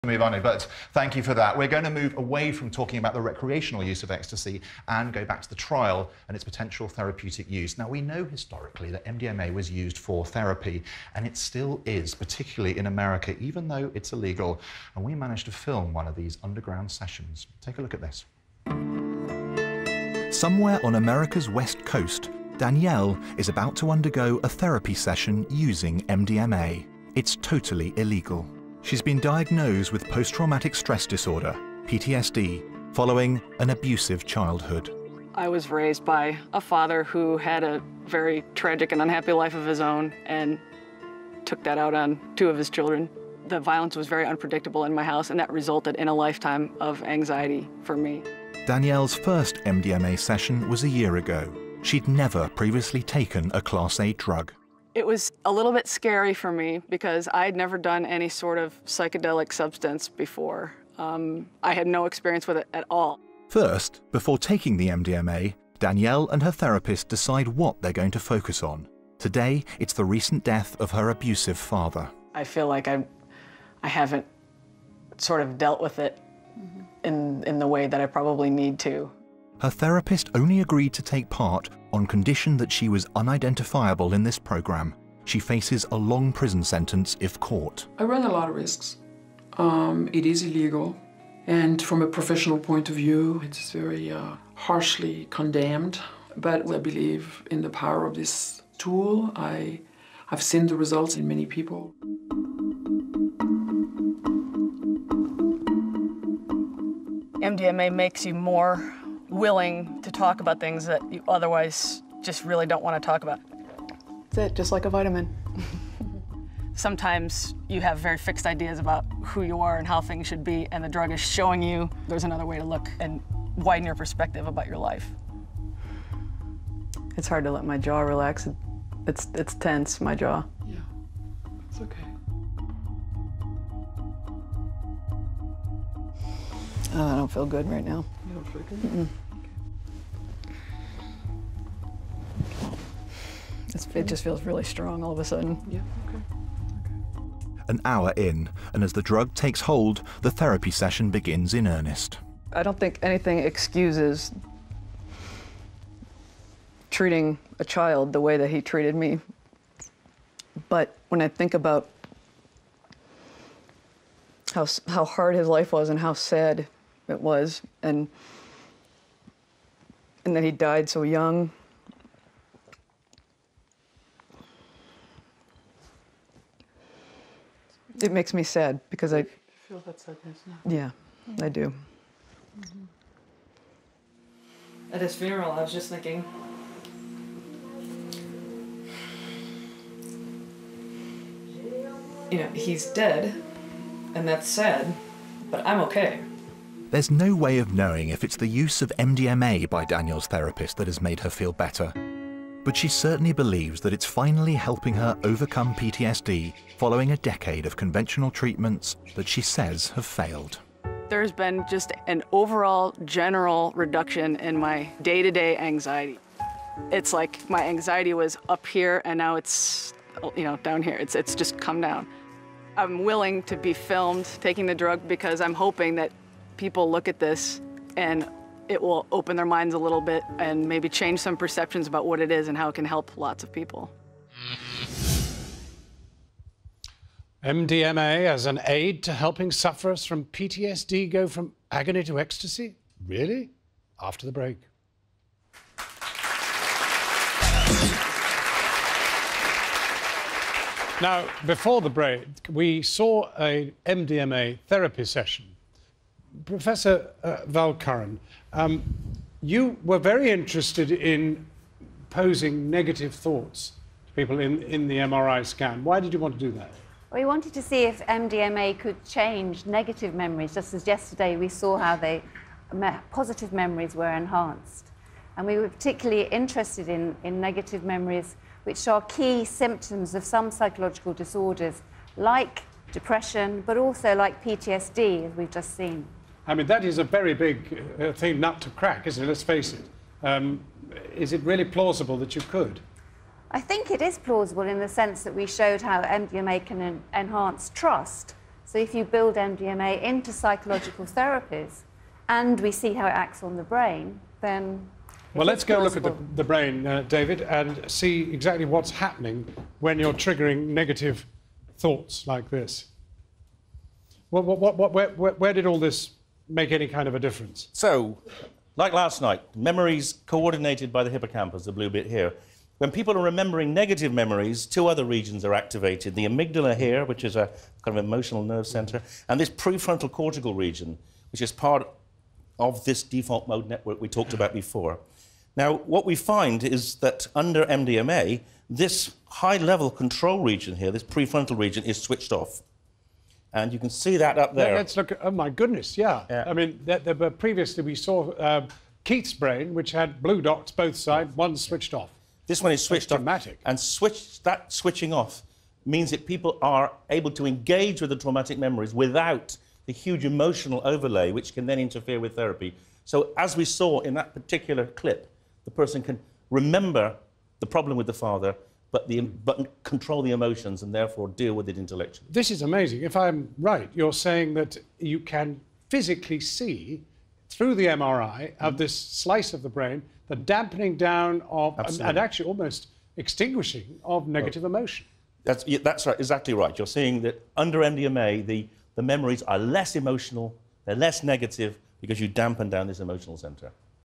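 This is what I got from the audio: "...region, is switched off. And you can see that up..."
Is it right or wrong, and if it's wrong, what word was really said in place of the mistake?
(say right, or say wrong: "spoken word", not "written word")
right.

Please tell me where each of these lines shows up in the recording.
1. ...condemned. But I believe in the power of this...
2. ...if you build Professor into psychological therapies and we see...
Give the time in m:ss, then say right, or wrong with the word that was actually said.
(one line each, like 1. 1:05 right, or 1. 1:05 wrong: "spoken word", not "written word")
1. 1:35 right
2. 4:58 wrong: "MDMA", not "Professor".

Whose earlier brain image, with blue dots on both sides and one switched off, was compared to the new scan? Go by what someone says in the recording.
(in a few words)
Keith.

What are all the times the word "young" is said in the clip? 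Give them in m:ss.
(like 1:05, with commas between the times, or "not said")
2:51.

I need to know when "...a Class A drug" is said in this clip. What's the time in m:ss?
0:53.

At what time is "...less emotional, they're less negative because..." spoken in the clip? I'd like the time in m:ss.
6:29.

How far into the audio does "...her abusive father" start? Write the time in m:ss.
1:10.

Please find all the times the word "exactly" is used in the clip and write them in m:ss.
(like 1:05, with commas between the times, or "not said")
5:08, 6:26.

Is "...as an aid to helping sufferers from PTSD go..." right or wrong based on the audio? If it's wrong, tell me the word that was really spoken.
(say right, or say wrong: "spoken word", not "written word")
right.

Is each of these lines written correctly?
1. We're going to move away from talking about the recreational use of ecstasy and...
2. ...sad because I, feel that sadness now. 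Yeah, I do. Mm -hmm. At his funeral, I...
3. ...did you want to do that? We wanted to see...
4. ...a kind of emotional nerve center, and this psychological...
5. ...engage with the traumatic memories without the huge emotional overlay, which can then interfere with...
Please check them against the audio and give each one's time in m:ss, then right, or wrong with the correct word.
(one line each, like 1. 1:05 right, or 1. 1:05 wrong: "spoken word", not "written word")
1. 0:01 right
2. 2:58 right
3. 4:25 right
4. 5:27 wrong: "prefrontal", not "psychological"
5. 5:57 right.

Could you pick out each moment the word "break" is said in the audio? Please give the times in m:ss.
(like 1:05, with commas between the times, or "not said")
4:04, 4:11.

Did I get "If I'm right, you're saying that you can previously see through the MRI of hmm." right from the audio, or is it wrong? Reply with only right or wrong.
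wrong.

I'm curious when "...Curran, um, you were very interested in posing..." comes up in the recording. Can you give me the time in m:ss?
4:17.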